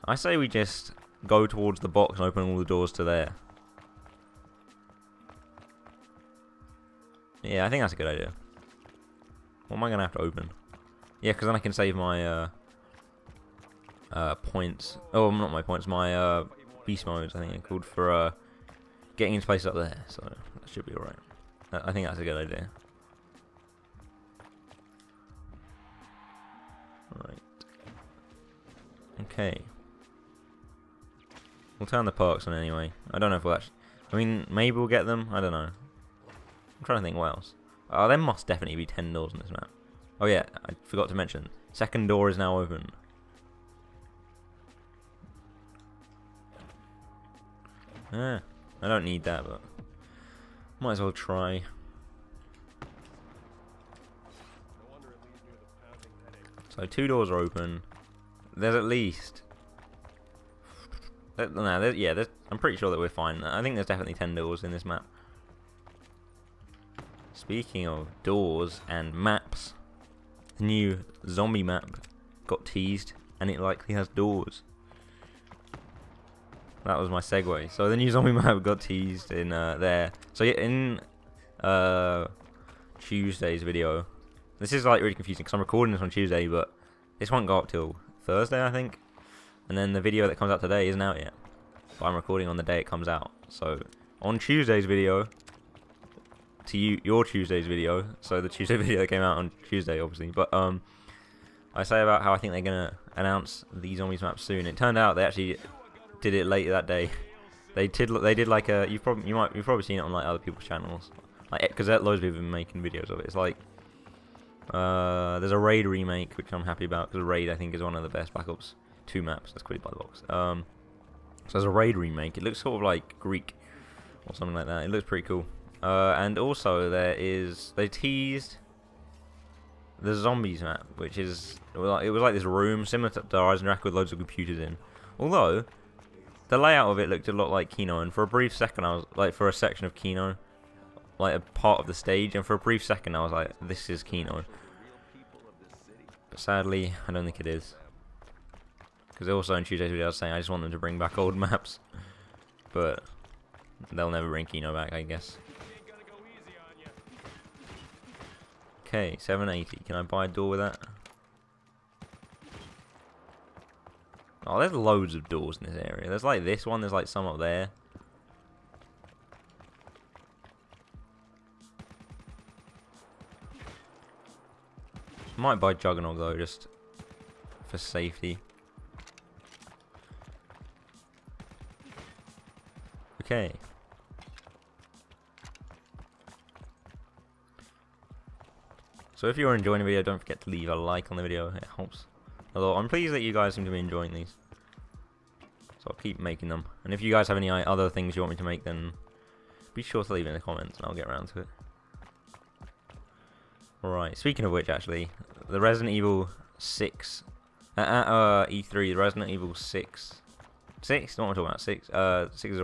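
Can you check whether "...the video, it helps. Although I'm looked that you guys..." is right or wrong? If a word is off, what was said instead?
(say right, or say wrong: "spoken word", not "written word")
wrong: "pleased", not "looked".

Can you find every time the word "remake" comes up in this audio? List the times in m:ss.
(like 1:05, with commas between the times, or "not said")
1:55, 2:01.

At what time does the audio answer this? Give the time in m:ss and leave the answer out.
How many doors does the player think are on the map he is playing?
0:38.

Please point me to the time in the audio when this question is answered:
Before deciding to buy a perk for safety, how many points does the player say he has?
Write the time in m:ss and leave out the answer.
2:39.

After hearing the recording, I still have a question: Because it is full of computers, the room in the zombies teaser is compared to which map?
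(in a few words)
Horizon Rack.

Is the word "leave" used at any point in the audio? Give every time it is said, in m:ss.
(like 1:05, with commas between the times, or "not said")
3:10, 3:20.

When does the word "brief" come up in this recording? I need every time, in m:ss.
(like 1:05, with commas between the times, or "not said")
2:18, 2:22.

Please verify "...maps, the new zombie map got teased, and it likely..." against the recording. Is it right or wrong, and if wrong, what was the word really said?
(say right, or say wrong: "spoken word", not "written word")
right.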